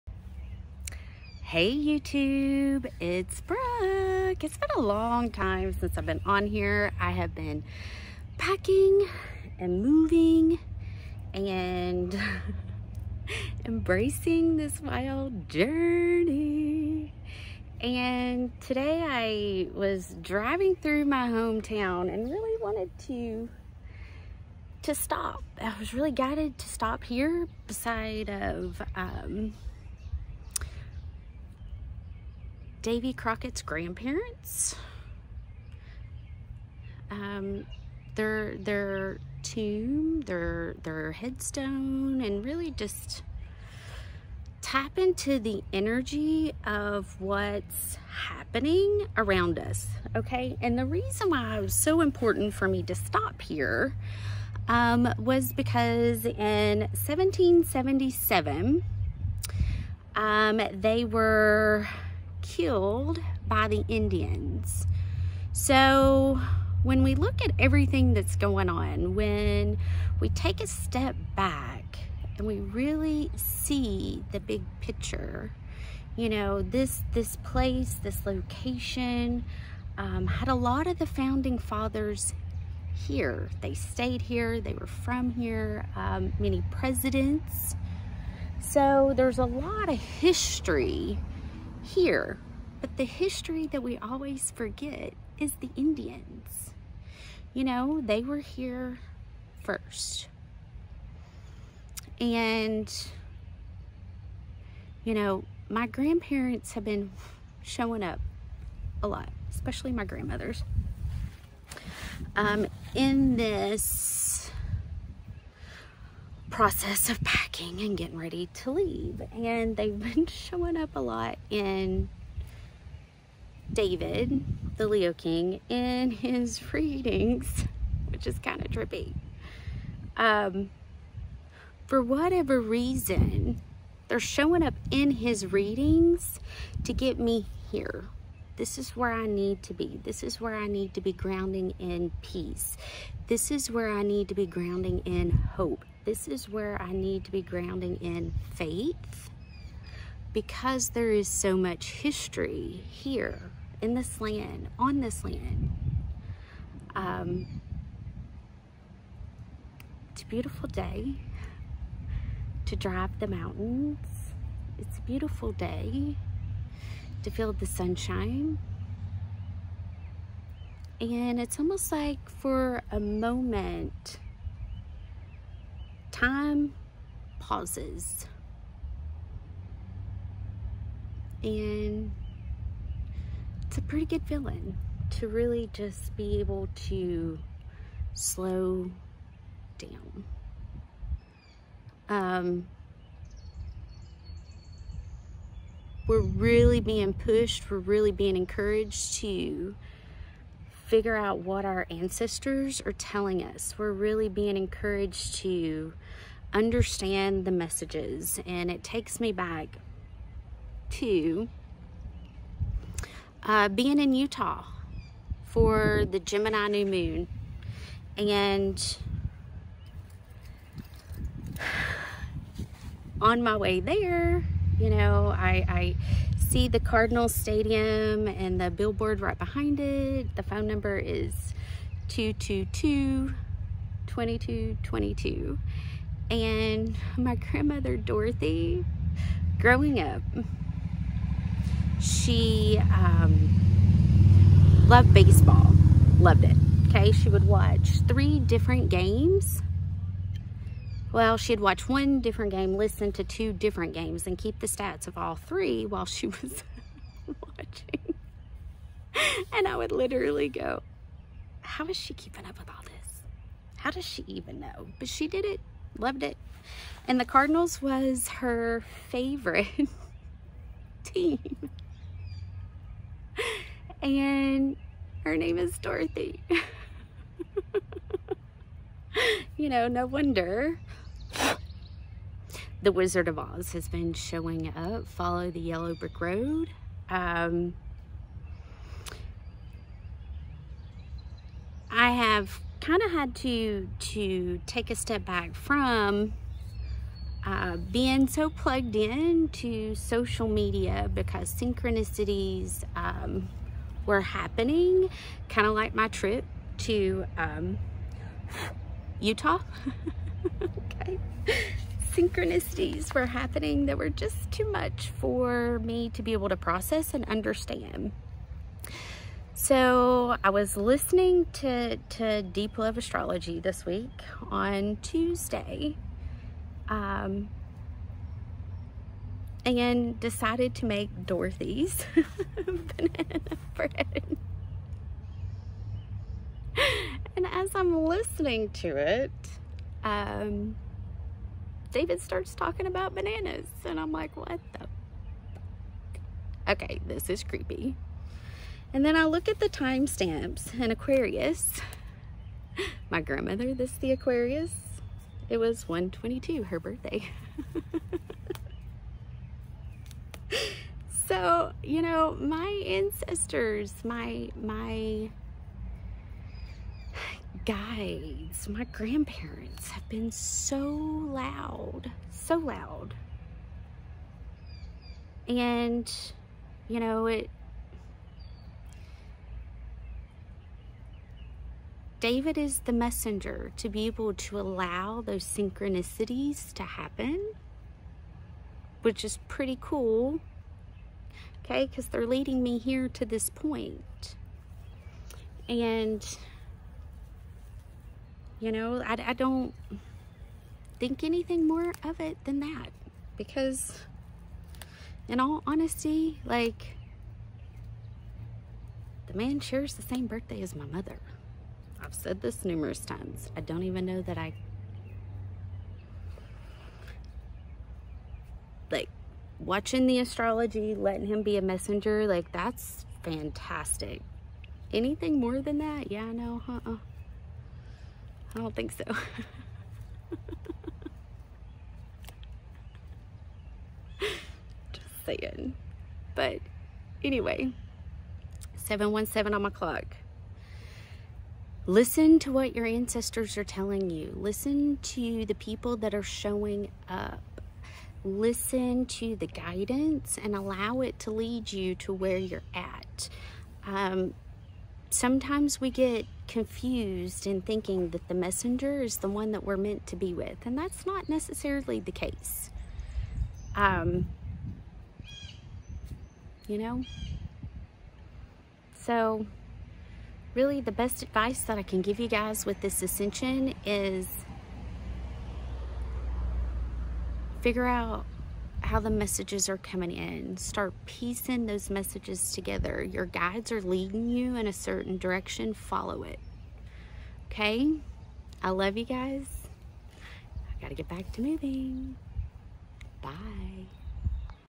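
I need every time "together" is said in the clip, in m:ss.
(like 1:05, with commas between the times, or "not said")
8:02.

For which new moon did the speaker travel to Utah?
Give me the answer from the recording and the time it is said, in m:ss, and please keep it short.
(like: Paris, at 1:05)
Gemini new moon, at 3:36.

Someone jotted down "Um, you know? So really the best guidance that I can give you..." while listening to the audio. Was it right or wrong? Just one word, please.
wrong.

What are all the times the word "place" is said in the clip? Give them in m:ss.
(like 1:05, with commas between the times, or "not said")
1:17.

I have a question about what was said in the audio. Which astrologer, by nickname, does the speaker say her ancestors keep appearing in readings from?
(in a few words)
David, the Leo King.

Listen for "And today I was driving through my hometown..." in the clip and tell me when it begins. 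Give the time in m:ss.
0:17.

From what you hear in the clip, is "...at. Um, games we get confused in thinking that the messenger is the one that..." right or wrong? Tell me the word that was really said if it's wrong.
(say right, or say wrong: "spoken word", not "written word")
wrong: "sometimes", not "games".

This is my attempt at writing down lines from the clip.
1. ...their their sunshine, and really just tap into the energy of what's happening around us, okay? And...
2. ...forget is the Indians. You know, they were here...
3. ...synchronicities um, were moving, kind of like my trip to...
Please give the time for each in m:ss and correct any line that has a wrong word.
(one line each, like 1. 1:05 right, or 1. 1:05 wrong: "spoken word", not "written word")
1. 0:40 wrong: "headstone", not "sunshine"
2. 1:34 right
3. 5:01 wrong: "happening", not "moving".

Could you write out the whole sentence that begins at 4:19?
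And I would literally go, how is she keeping up with all this?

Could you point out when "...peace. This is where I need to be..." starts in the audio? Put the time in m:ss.
2:22.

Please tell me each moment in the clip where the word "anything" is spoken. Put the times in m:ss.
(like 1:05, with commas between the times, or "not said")
6:41, 7:04.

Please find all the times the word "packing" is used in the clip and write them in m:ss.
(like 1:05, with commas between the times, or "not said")
0:08, 1:57.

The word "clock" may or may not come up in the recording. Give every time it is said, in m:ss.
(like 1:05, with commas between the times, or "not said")
7:19.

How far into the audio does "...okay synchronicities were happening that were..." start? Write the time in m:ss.
5:10.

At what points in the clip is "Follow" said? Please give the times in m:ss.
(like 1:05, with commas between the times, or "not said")
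4:45, 8:05.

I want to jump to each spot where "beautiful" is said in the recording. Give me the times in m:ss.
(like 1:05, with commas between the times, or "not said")
2:40, 2:45.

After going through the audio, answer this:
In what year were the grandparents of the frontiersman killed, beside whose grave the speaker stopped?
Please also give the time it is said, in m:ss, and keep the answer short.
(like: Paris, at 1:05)
1777, at 0:56.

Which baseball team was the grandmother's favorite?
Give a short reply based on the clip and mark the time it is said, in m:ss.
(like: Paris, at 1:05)
Cardinals, at 4:27.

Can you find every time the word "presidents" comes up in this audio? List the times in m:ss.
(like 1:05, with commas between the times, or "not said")
1:26.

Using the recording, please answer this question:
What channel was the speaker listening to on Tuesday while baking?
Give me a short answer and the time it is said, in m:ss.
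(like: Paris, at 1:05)
Deep Love Astrology, at 5:22.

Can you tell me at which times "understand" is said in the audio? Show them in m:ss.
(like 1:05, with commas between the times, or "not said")
3:26, 5:17.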